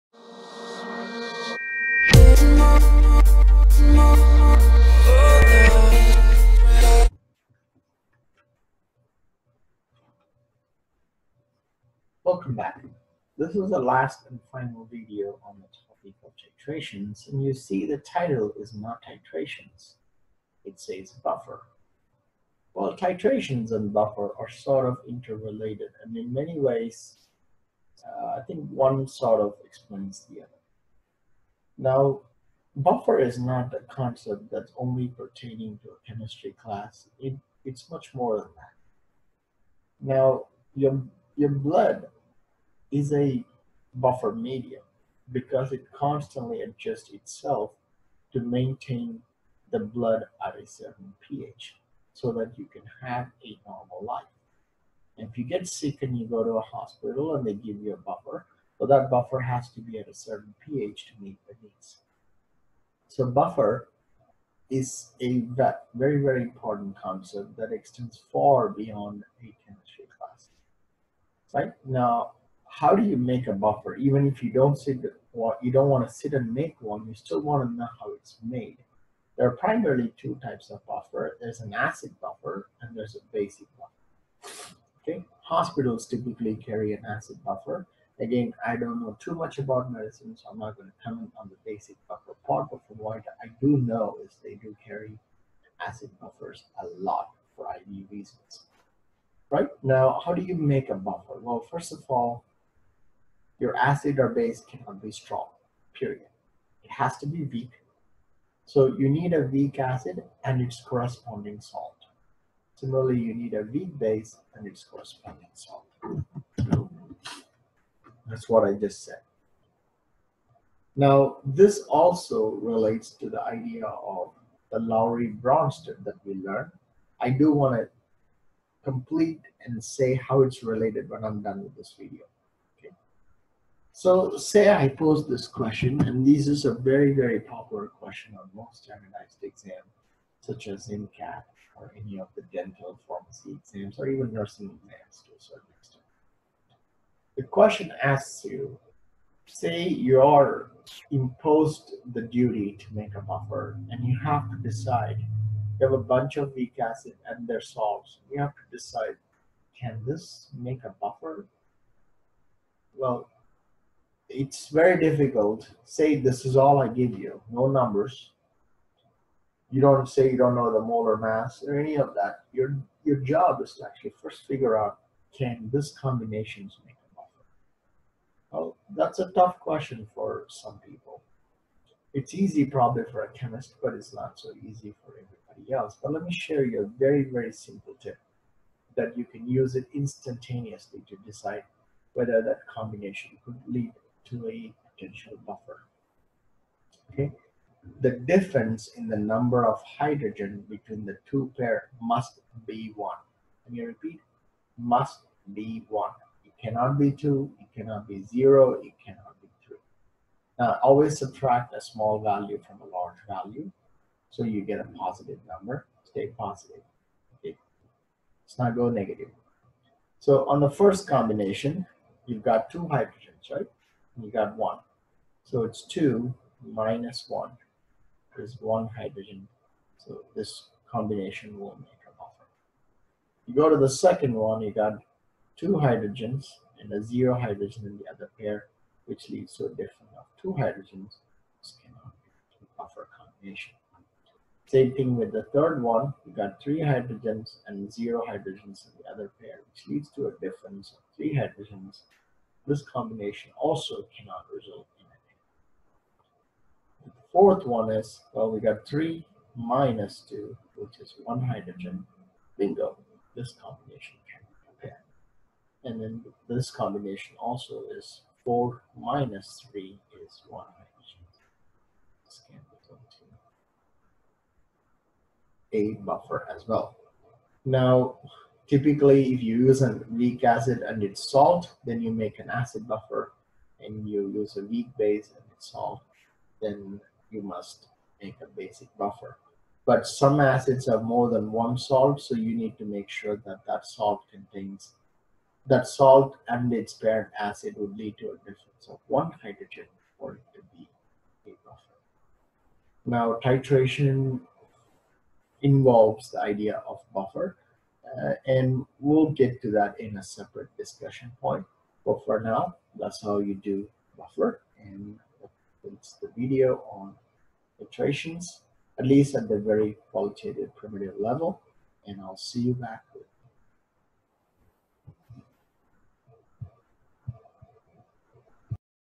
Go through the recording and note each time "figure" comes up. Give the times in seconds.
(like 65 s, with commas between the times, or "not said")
174 s.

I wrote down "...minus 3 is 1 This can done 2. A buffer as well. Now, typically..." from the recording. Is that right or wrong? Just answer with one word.
right.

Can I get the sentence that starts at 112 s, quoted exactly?
Similarly, you need a weak base and its corresponding salt.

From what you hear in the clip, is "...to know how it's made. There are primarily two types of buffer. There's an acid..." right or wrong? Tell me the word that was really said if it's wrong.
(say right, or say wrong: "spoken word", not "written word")
right.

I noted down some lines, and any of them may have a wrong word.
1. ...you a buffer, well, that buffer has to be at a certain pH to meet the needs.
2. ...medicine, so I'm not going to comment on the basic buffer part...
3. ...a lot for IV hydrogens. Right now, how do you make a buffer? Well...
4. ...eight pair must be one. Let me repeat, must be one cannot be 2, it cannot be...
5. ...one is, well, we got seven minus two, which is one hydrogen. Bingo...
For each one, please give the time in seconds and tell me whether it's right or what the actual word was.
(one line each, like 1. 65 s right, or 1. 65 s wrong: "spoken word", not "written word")
1. 57 s right
2. 89 s right
3. 96 s wrong: "reasons", not "hydrogens"
4. 201 s wrong: "two", not "eight"
5. 257 s wrong: "three", not "seven".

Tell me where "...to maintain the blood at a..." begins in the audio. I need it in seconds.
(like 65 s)
48 s.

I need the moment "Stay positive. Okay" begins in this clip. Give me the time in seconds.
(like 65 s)
216 s.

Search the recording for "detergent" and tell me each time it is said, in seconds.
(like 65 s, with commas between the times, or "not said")
not said.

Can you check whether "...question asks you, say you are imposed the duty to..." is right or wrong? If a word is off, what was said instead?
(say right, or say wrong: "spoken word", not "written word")
right.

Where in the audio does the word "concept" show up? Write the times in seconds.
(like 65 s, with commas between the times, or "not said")
33 s, 66 s.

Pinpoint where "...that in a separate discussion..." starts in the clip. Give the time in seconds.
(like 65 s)
309 s.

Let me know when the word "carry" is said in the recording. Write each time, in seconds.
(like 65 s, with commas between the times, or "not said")
86 s, 94 s.